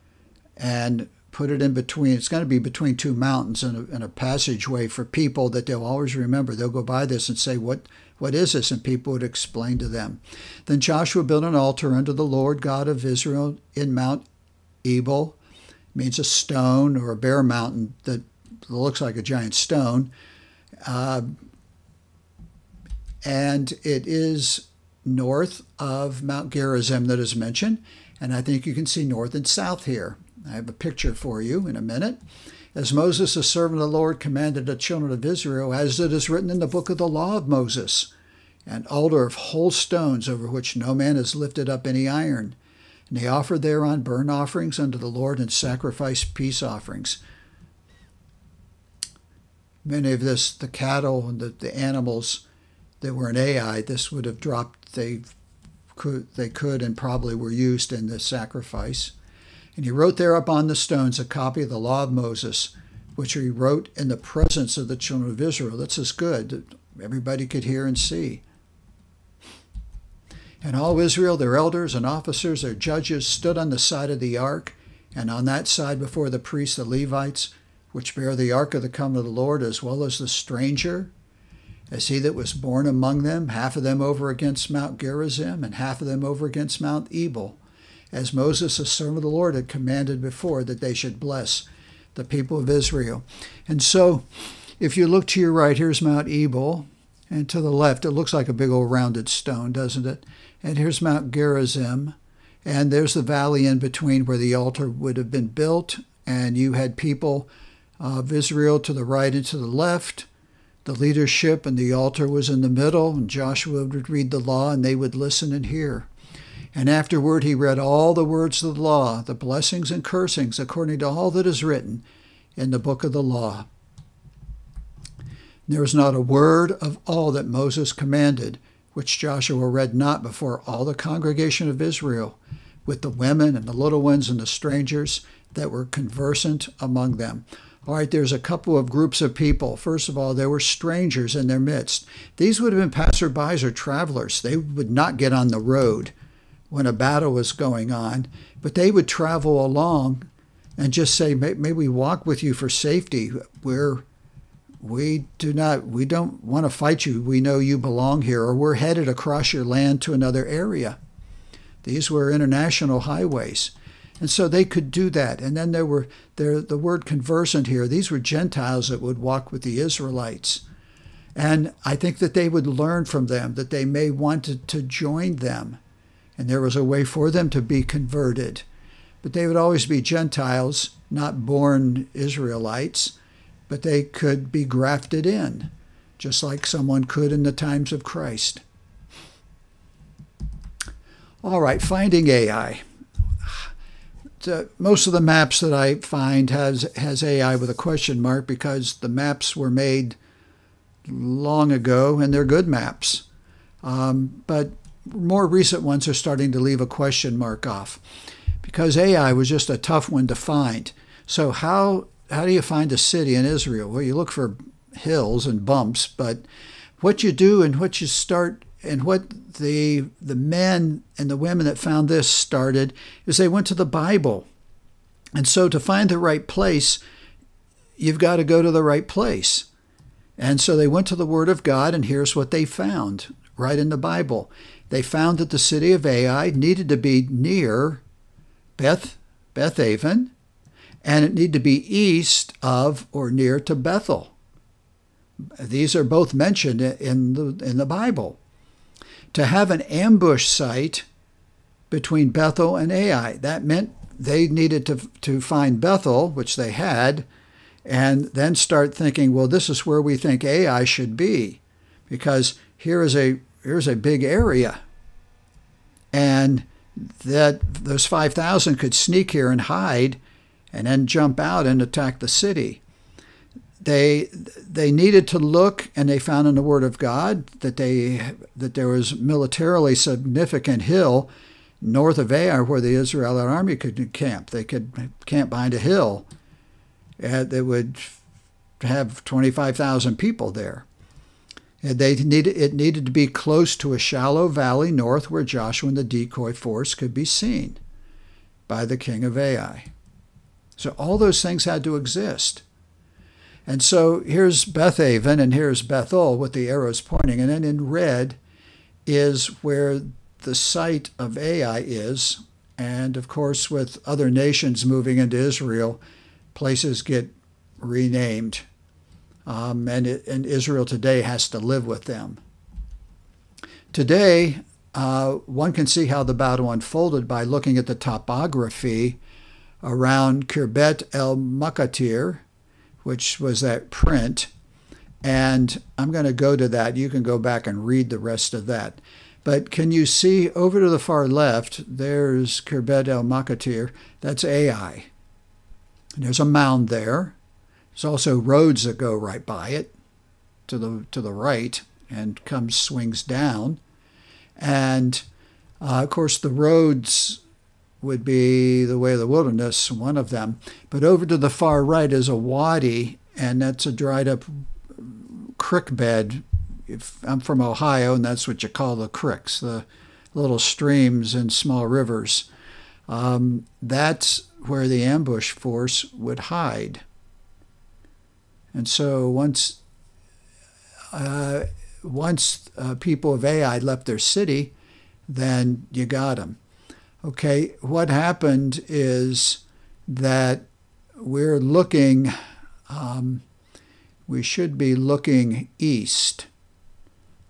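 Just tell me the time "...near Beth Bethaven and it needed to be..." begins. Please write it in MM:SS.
03:57.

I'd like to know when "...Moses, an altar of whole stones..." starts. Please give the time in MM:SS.
00:37.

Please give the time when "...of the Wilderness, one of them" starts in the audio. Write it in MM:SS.
05:59.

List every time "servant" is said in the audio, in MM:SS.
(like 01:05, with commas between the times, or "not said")
00:33, 01:28.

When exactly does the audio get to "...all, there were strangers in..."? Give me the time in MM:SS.
02:20.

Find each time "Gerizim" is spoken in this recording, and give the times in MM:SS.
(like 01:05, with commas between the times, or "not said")
00:26, 01:24, 01:41.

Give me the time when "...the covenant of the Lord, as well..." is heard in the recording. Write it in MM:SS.
01:18.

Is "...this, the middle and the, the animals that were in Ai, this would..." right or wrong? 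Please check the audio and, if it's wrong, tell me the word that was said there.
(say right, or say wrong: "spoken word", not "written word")
wrong: "cattle", not "middle".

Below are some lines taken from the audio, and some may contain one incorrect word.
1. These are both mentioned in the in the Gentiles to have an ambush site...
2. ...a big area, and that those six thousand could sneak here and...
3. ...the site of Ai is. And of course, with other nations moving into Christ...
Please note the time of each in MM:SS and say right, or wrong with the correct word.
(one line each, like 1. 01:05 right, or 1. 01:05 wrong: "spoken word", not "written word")
1. 04:05 wrong: "Bible", not "Gentiles"
2. 04:23 wrong: "five", not "six"
3. 05:10 wrong: "Israel", not "Christ".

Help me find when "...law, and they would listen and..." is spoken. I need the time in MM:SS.
01:54.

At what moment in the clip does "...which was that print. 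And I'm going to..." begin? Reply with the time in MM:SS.
05:33.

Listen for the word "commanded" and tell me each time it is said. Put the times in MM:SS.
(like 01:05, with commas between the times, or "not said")
00:34, 01:29, 02:07.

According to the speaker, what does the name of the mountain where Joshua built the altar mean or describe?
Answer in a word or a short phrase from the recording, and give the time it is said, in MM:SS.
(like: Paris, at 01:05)
A stone or a bare mountain, at 00:16.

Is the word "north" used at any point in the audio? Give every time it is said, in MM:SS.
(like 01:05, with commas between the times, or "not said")
00:25, 00:29, 04:41, 04:54.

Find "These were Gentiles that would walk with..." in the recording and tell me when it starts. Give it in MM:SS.
02:47.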